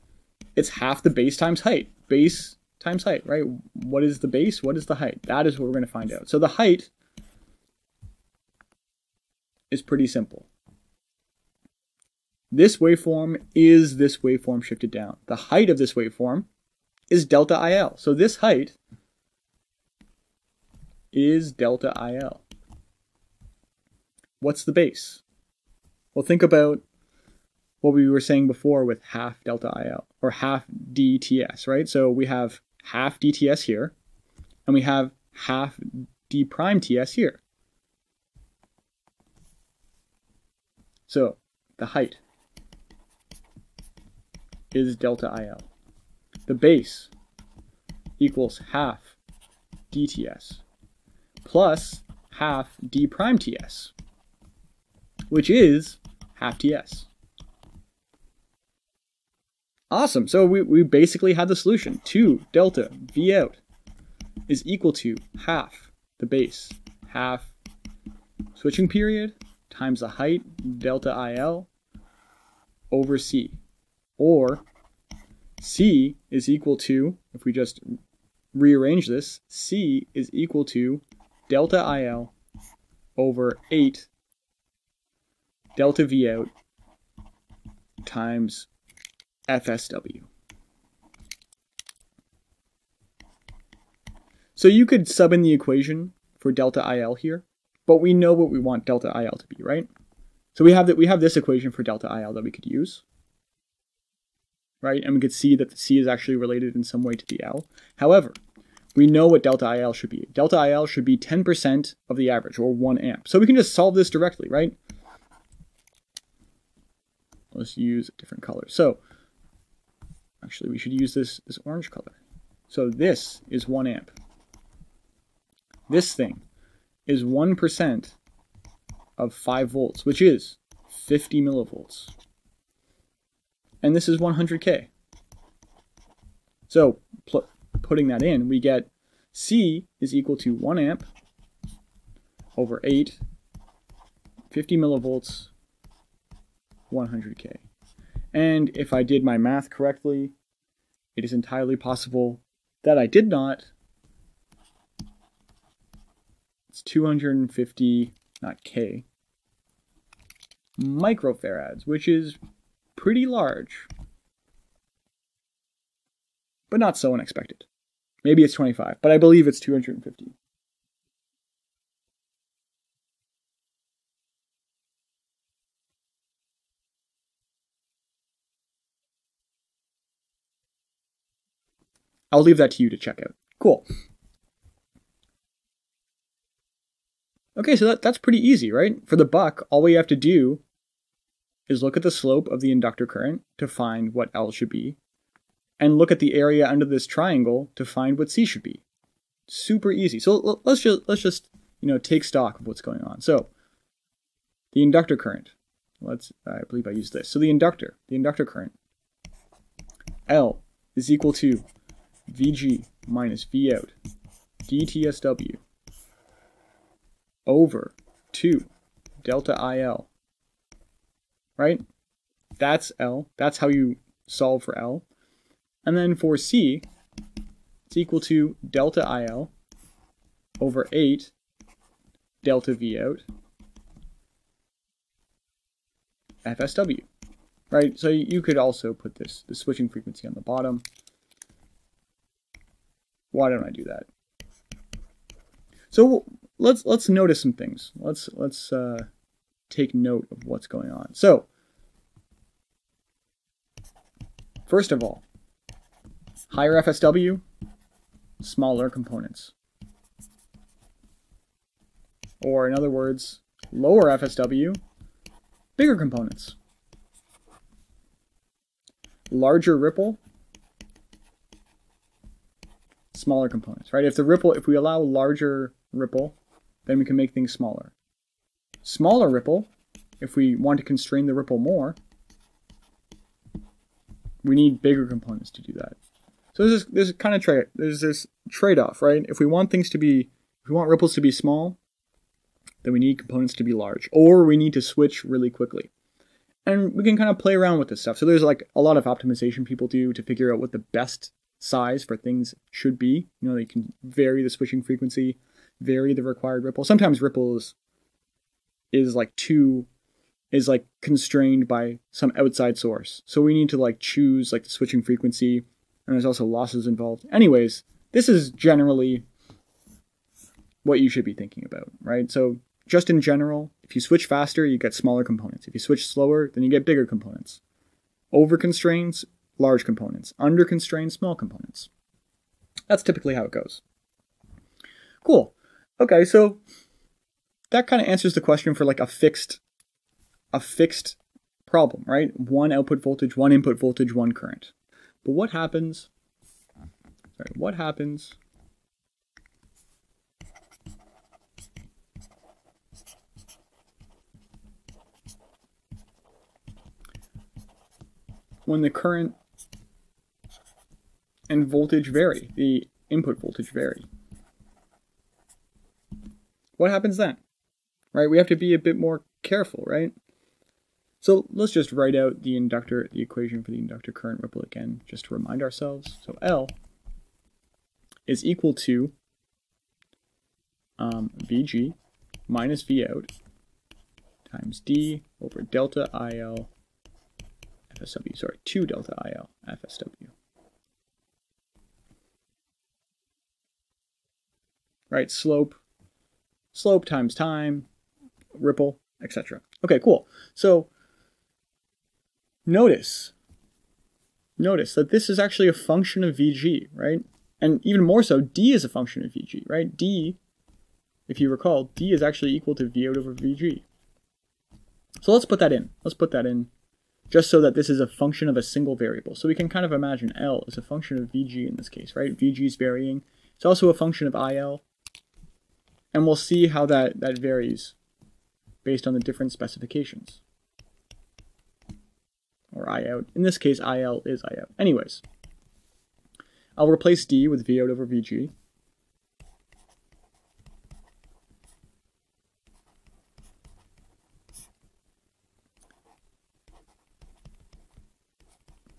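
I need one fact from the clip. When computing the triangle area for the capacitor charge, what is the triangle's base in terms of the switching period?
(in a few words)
half TS.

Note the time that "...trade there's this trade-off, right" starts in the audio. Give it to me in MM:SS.
04:47.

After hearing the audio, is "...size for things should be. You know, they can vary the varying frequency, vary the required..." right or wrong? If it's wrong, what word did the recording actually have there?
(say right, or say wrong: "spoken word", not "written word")
wrong: "switching", not "varying".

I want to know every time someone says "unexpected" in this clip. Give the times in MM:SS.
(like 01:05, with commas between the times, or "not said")
02:47.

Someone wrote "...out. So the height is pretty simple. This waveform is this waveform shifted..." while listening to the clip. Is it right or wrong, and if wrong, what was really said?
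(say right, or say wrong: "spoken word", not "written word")
right.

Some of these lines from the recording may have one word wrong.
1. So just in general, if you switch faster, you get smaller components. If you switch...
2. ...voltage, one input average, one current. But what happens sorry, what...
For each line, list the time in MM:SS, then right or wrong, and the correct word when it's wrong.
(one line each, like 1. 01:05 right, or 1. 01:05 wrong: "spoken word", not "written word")
1. 05:22 right
2. 05:43 wrong: "voltage", not "average".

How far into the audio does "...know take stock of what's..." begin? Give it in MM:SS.
03:21.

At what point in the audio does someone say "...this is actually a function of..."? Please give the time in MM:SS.
06:45.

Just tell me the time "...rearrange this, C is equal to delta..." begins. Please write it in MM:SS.
01:18.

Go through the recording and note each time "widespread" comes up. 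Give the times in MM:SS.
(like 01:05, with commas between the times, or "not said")
not said.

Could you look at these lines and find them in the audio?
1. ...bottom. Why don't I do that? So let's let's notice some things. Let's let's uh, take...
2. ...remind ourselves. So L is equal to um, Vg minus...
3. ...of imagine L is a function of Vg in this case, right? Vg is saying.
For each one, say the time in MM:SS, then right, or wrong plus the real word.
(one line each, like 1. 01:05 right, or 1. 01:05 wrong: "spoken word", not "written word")
1. 04:00 right
2. 06:15 right
3. 06:59 wrong: "varying", not "saying".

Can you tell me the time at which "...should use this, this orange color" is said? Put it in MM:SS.
02:00.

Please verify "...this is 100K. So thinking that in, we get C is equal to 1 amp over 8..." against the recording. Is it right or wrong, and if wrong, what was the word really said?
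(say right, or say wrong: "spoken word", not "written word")
wrong: "putting", not "thinking".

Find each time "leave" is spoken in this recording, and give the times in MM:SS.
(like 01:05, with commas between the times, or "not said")
03:02.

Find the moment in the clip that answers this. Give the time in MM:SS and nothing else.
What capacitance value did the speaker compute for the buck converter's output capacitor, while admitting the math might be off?
02:36.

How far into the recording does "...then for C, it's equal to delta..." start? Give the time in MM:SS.
03:45.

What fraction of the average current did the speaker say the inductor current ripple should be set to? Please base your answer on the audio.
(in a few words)
10%.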